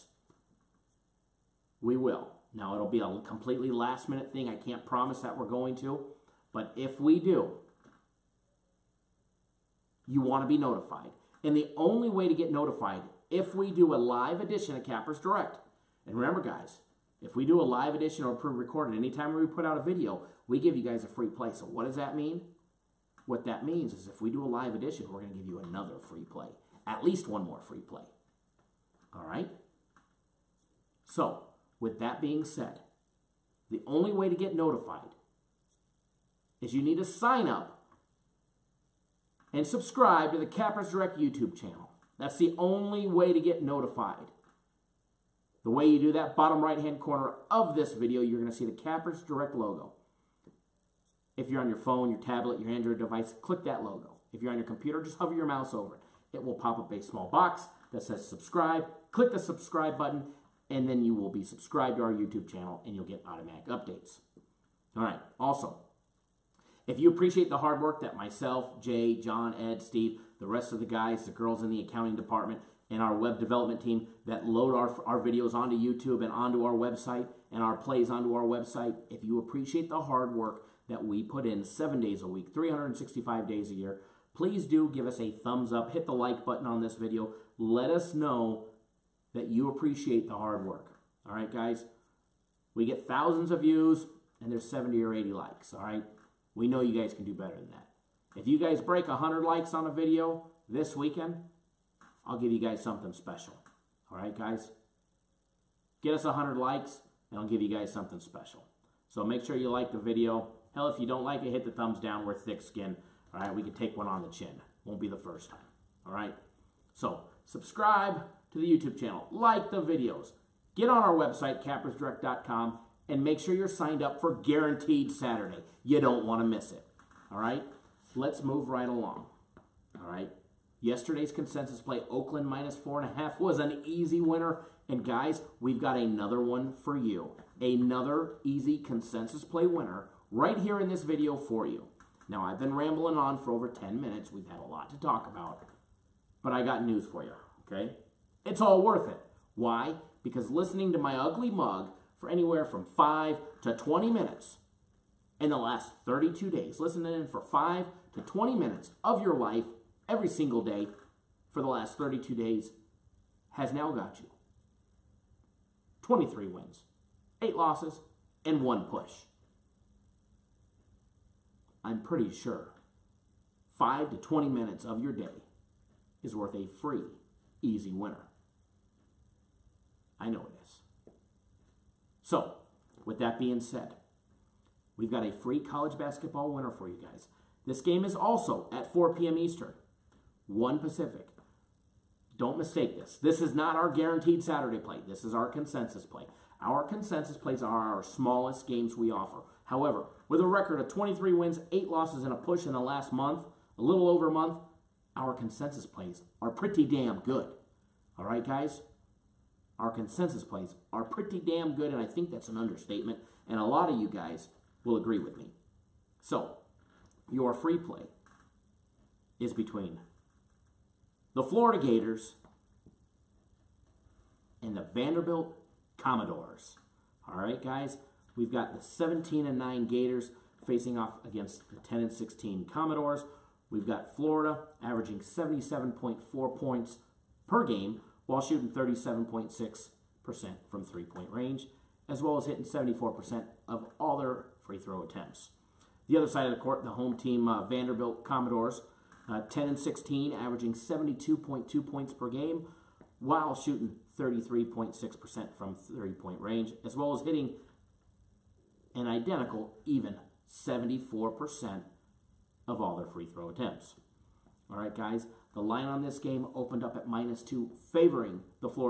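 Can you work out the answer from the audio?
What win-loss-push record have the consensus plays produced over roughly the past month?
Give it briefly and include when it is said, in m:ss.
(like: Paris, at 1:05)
23-8-1, at 2:46.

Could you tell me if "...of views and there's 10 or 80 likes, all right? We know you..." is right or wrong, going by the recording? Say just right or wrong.
wrong.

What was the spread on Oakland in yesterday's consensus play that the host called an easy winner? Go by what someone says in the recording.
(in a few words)
-4.5.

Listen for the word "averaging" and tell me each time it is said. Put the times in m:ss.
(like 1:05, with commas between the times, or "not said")
3:54, 4:10.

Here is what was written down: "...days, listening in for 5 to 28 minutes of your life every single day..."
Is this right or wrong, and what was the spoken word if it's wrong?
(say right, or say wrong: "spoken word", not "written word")
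wrong: "20", not "28".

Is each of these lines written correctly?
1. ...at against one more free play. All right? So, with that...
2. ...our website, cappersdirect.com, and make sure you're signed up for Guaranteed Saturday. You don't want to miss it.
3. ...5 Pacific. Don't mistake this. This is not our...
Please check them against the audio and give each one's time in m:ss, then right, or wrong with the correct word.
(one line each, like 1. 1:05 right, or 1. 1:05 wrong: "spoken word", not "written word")
1. 0:26 wrong: "least", not "against"
2. 2:01 right
3. 3:10 wrong: "1", not "5".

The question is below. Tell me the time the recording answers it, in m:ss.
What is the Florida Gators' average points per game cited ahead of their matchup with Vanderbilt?
3:55.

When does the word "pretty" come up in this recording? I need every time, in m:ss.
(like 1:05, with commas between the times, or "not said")
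2:52, 3:26, 3:31.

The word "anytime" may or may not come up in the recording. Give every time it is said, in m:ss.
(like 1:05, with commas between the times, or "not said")
0:18.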